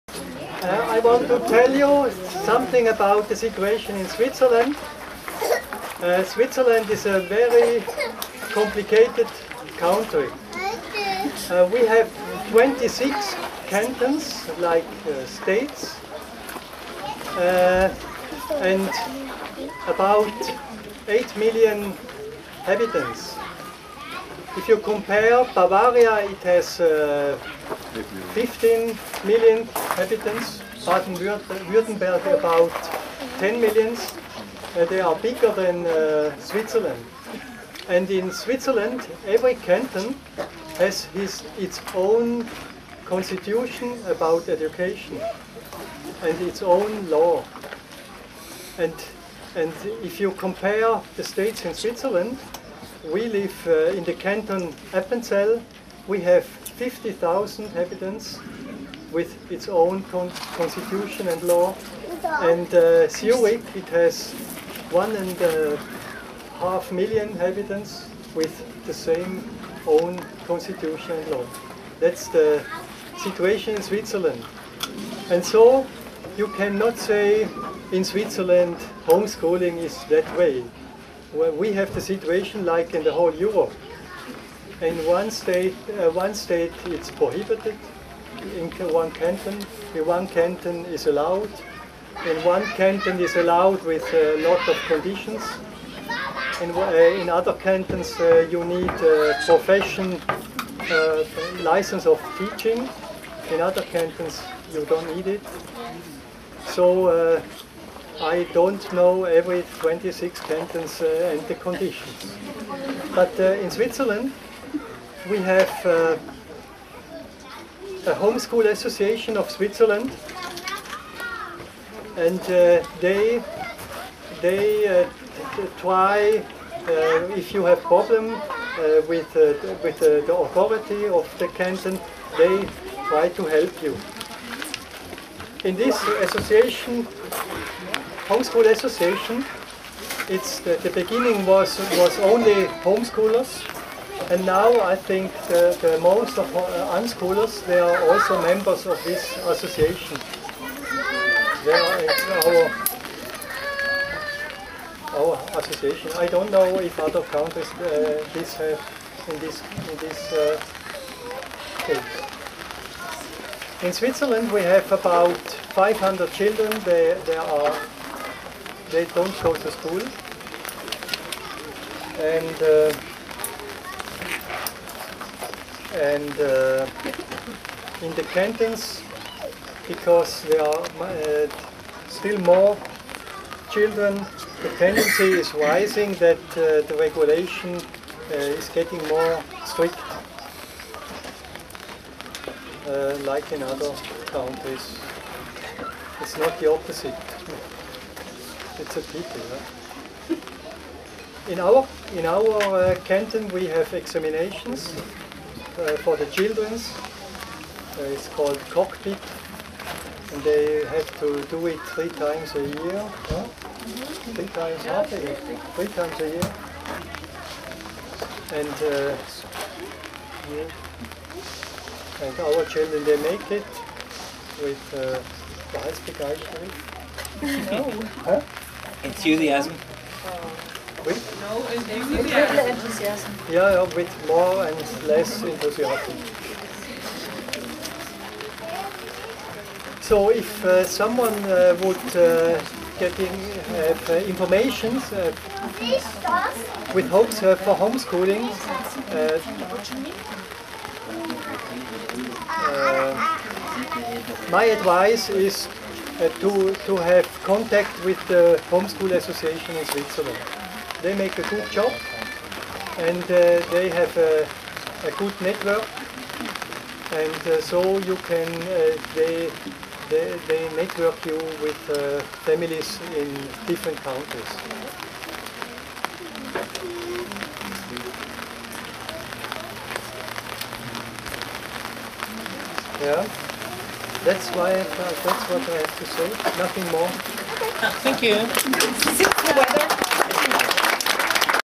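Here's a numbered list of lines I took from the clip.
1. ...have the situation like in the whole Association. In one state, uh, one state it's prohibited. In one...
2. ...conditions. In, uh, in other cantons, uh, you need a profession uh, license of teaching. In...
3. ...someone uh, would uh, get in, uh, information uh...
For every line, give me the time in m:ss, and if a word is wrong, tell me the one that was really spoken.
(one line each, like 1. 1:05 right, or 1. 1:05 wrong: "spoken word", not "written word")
1. 1:21 wrong: "Europe", not "Association"
2. 1:34 right
3. 4:00 right.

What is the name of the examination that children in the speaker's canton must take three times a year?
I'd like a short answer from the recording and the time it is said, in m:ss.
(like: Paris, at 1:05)
Cockpit, at 3:28.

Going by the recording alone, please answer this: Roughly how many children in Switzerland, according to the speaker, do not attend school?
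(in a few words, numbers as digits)
About 500.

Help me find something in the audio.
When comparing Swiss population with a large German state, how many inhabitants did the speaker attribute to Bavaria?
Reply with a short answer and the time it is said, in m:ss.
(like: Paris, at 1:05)
15 million, at 0:28.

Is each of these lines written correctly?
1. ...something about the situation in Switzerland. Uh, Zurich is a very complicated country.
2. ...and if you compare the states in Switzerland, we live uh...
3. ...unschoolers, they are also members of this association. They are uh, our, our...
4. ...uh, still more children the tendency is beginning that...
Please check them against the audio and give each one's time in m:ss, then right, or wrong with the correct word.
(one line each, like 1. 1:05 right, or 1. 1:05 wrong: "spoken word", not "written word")
1. 0:02 wrong: "Switzerland", not "Zurich"
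2. 0:49 right
3. 2:26 right
4. 3:01 wrong: "rising", not "beginning".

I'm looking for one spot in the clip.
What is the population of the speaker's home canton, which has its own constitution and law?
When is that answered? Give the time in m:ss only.
0:56.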